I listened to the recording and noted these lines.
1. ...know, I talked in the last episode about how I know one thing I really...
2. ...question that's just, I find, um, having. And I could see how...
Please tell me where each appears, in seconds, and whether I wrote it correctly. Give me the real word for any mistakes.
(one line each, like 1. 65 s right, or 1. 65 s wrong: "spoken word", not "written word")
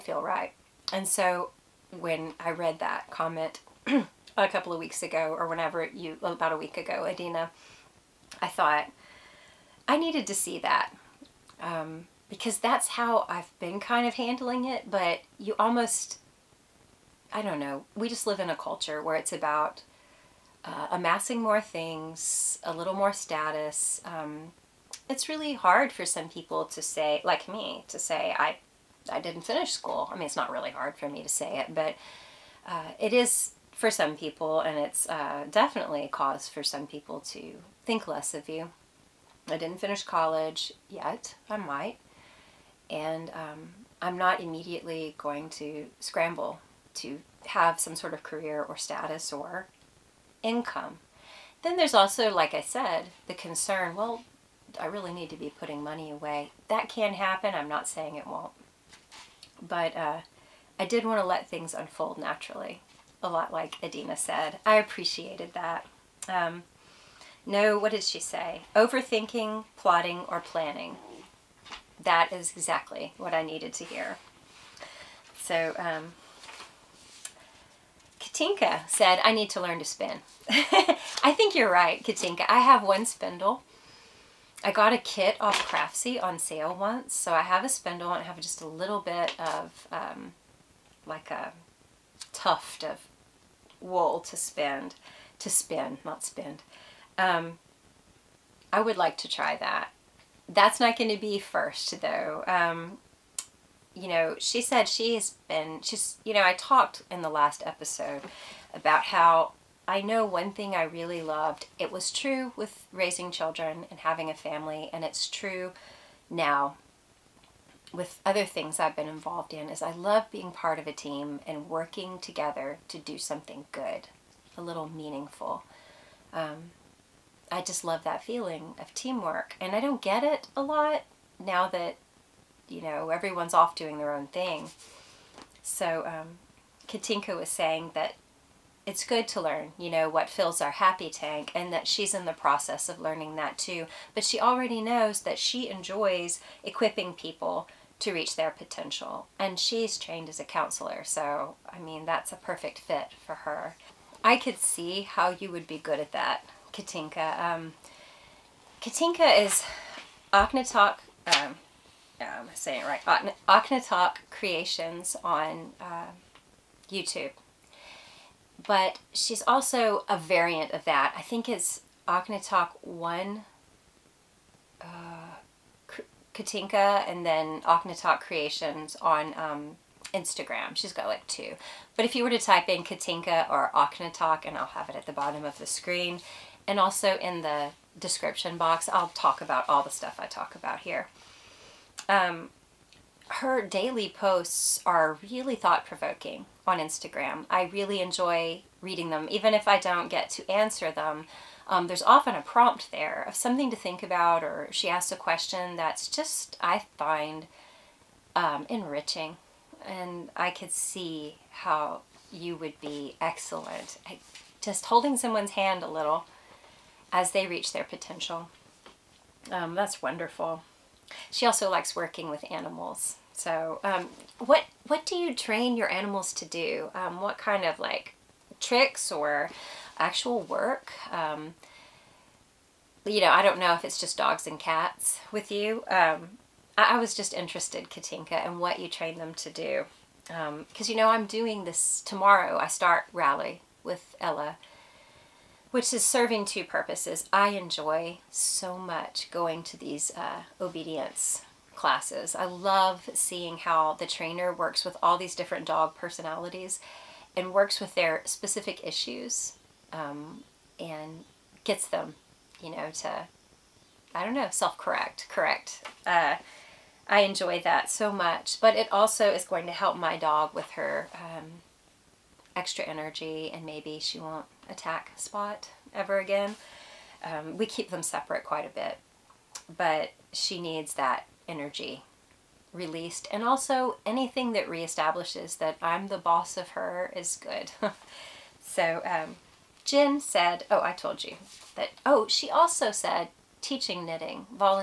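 1. 106 s right
2. 205 s wrong: "enriching", not "having".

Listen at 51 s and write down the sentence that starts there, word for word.
Then there's also, like I said, the concern well, I really need to be putting money away.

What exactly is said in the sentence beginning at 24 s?
Um, it's really hard for some people to say, like me, to say, I, I didn't finish school.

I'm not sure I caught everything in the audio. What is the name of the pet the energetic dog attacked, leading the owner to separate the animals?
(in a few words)
Spot.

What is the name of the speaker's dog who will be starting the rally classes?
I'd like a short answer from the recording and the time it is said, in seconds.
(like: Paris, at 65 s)
Ella, at 244 s.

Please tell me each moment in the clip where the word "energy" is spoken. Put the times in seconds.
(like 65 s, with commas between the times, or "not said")
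272 s, 281 s.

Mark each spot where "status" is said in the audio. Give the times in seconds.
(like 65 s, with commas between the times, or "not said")
23 s, 48 s.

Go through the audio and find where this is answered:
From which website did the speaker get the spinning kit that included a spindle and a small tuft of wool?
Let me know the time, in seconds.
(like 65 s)
85 s.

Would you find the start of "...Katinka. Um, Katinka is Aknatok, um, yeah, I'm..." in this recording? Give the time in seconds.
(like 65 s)
156 s.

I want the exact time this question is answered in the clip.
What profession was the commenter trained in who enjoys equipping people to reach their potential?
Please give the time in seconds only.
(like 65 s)
150 s.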